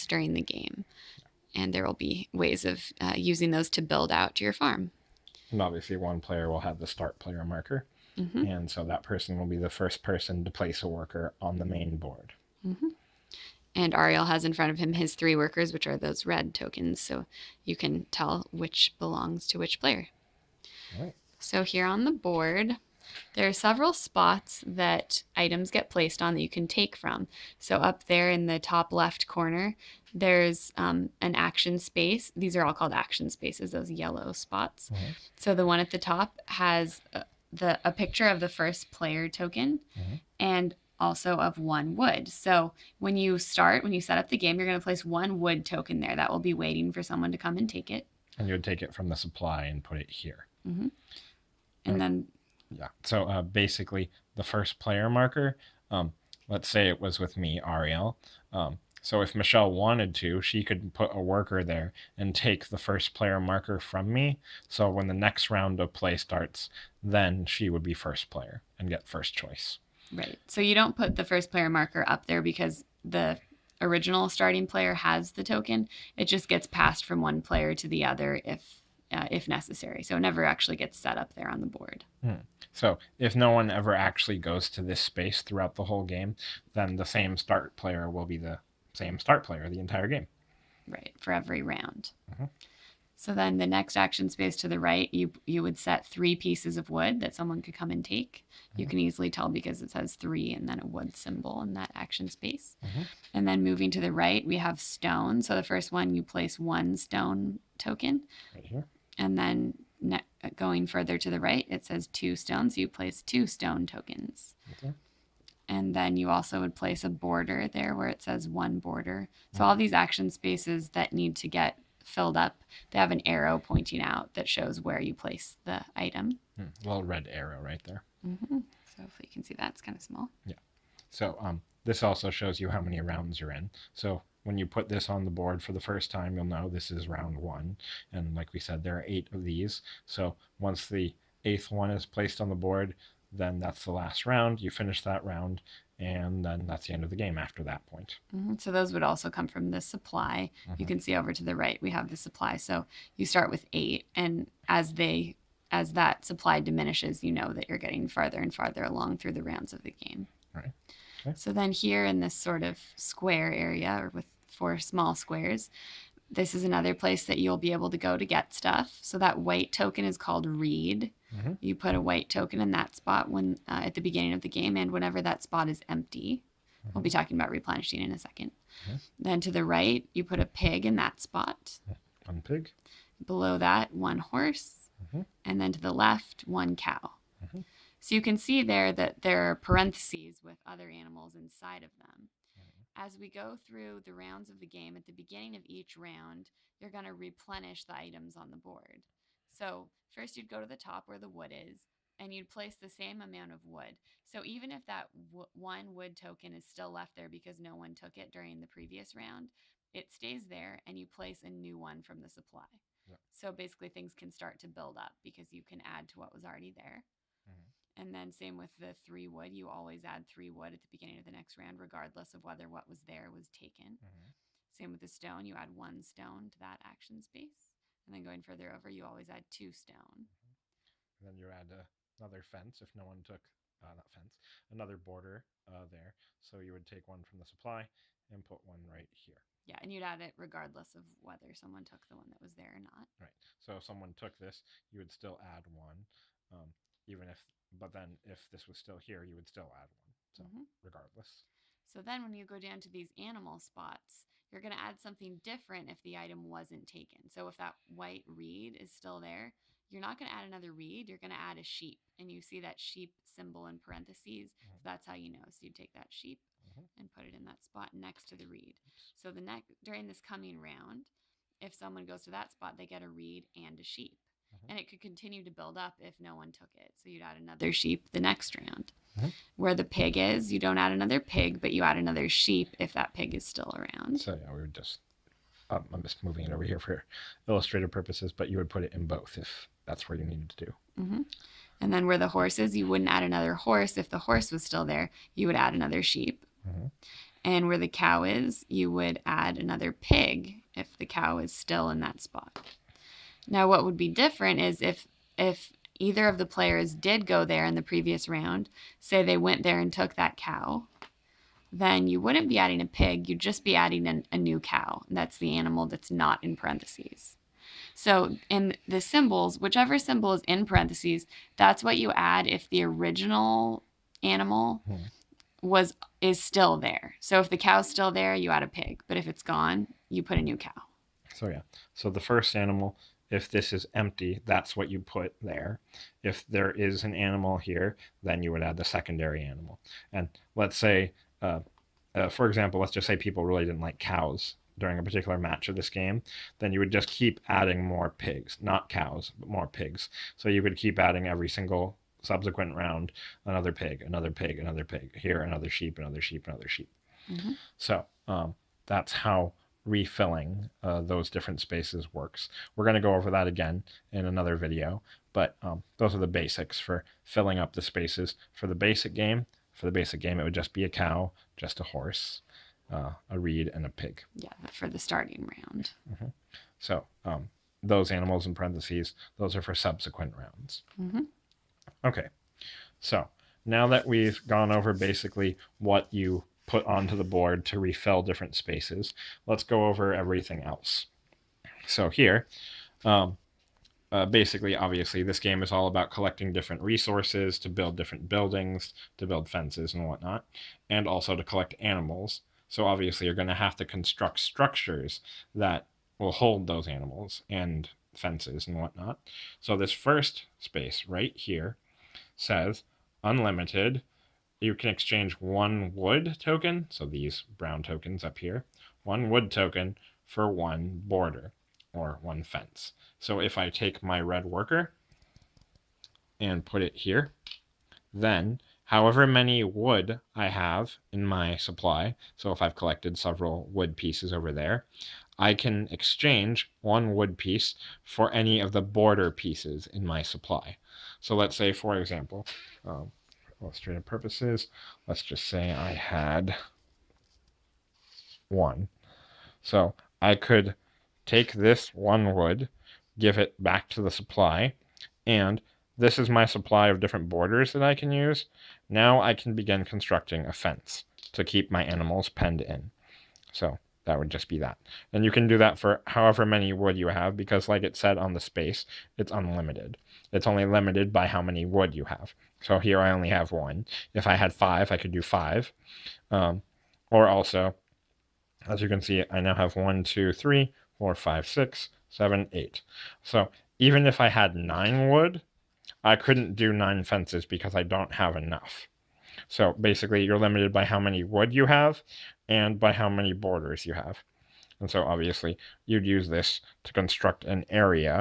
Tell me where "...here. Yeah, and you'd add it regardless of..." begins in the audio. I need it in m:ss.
3:59.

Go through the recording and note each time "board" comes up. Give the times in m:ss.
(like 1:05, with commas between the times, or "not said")
0:11, 0:22, 1:21, 2:15, 2:22, 3:18, 6:27.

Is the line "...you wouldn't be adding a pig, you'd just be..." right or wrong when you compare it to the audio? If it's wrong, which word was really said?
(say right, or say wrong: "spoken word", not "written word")
right.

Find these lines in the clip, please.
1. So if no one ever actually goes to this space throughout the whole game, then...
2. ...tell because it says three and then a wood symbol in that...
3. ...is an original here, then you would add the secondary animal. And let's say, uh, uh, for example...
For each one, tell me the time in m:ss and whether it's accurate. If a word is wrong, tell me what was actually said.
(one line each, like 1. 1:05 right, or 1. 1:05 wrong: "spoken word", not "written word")
1. 1:22 right
2. 1:39 right
3. 5:36 wrong: "animal", not "original".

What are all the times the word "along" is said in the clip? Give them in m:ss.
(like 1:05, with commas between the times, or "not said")
2:38.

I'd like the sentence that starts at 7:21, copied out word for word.
So let's say, for example, um, illustrative purposes, let's just say I had one.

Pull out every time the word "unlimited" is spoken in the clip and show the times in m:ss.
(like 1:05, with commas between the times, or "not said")
6:53, 7:49.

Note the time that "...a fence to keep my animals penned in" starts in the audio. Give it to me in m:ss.
7:40.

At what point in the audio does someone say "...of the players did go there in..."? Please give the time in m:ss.
5:06.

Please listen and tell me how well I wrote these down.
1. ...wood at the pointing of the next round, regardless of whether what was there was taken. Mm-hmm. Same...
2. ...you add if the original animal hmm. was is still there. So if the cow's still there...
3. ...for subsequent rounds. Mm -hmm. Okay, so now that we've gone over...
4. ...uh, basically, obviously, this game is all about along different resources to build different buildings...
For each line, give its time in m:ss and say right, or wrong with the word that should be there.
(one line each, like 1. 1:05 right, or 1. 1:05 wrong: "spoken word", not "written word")
1. 3:40 wrong: "beginning", not "pointing"
2. 5:21 right
3. 6:19 right
4. 6:34 wrong: "collecting", not "along".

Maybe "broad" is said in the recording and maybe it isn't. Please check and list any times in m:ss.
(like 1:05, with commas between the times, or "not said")
not said.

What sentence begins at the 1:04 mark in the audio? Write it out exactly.
So when the next round of play starts, then she would be first player and get first choice.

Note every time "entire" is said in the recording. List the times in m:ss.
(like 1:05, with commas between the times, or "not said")
1:29.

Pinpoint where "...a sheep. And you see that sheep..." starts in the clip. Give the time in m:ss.
4:21.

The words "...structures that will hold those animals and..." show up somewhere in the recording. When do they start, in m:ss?
6:44.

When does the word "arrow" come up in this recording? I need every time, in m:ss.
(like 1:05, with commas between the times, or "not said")
2:03, 2:07.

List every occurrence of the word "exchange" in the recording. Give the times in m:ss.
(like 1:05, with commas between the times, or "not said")
6:54, 7:15.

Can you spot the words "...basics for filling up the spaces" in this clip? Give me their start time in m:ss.
6:06.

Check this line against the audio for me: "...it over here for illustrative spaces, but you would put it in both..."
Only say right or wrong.
wrong.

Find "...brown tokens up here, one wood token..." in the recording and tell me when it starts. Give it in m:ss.
6:57.